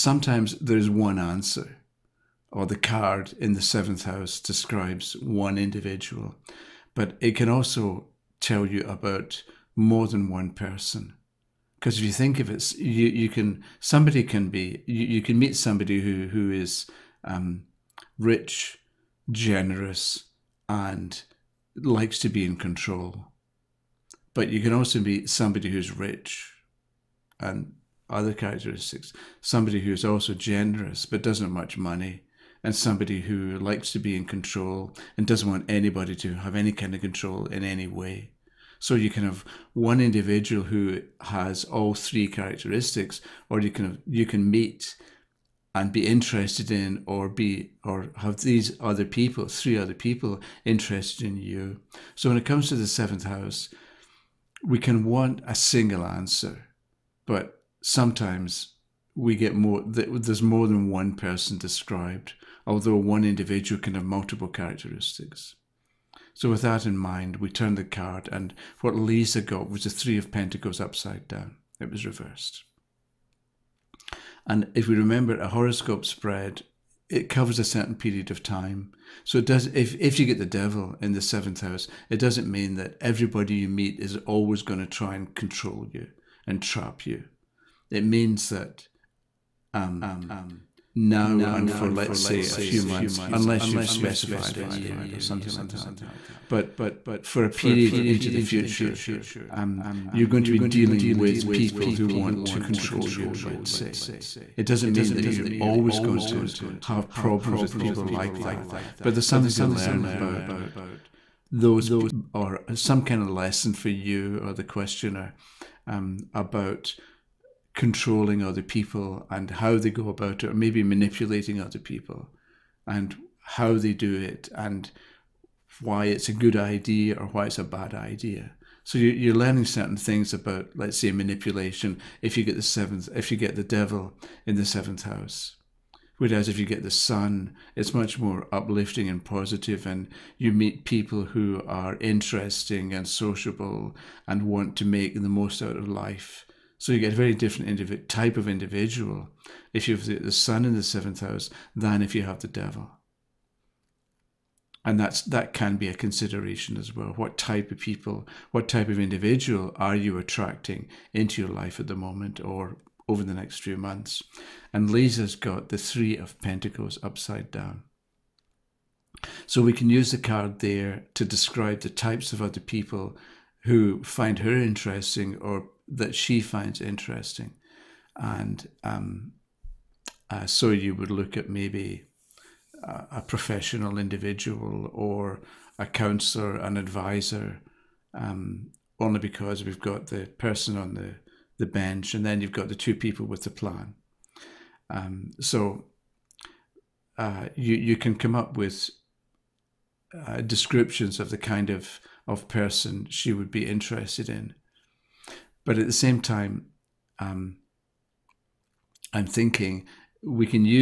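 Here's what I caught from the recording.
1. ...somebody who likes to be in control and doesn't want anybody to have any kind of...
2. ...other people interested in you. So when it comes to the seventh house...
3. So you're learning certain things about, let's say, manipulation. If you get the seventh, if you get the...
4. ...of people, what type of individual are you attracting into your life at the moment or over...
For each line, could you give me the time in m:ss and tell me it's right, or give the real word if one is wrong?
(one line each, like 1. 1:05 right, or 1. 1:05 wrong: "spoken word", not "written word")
1. 0:32 right
2. 0:49 right
3. 2:08 right
4. 2:37 right.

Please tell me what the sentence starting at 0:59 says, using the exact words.
There's more than one person described although one individual can have multiple characteristics.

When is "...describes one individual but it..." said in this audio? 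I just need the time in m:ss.
0:04.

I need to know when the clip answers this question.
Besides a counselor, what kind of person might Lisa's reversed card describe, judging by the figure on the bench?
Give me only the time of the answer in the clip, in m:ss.
3:03.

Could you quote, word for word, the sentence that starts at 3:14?
Um, so uh, you, you can come up with uh, descriptions of the kind of, of person she would be interested in.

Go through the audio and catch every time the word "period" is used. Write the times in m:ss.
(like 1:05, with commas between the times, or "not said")
1:17, 1:37.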